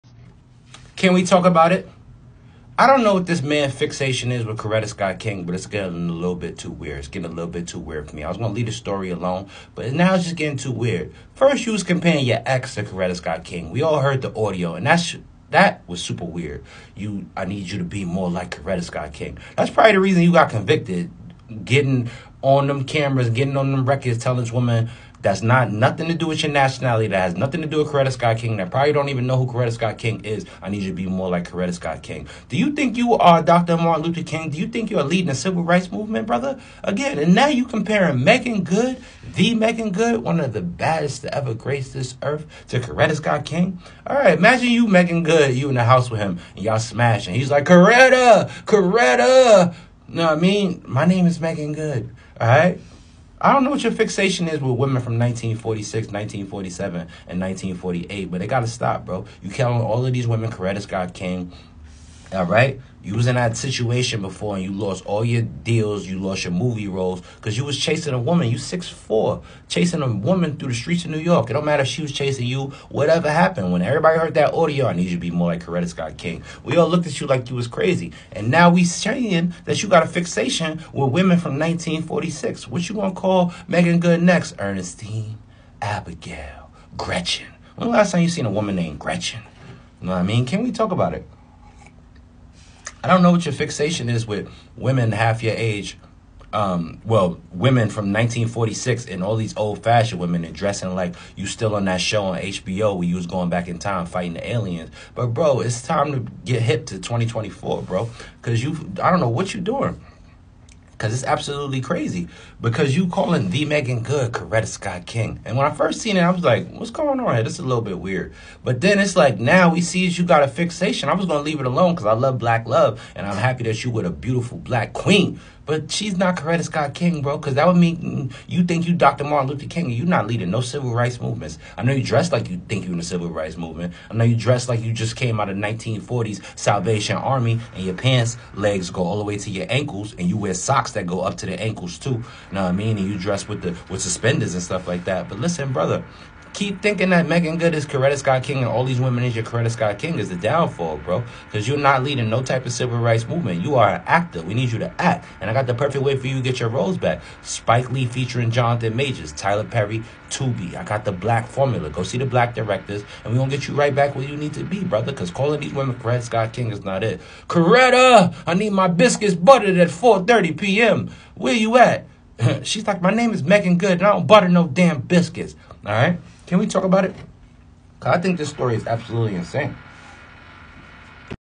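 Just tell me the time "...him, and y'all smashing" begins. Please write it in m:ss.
0:46.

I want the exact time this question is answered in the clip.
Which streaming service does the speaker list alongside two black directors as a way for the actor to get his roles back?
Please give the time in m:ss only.
2:40.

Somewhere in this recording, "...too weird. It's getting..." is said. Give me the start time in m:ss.
0:06.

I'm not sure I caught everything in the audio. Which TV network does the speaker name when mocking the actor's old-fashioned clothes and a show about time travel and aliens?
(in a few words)
HBO.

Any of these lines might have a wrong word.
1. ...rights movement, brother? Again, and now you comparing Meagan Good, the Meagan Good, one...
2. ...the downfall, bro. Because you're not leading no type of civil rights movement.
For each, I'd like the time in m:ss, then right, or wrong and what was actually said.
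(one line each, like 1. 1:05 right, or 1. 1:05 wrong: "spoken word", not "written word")
1. 0:35 right
2. 2:30 right.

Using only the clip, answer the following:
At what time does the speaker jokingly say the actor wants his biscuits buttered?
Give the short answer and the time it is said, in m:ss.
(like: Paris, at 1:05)
4:30 p.m., at 2:49.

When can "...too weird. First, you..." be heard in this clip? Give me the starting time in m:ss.
0:10.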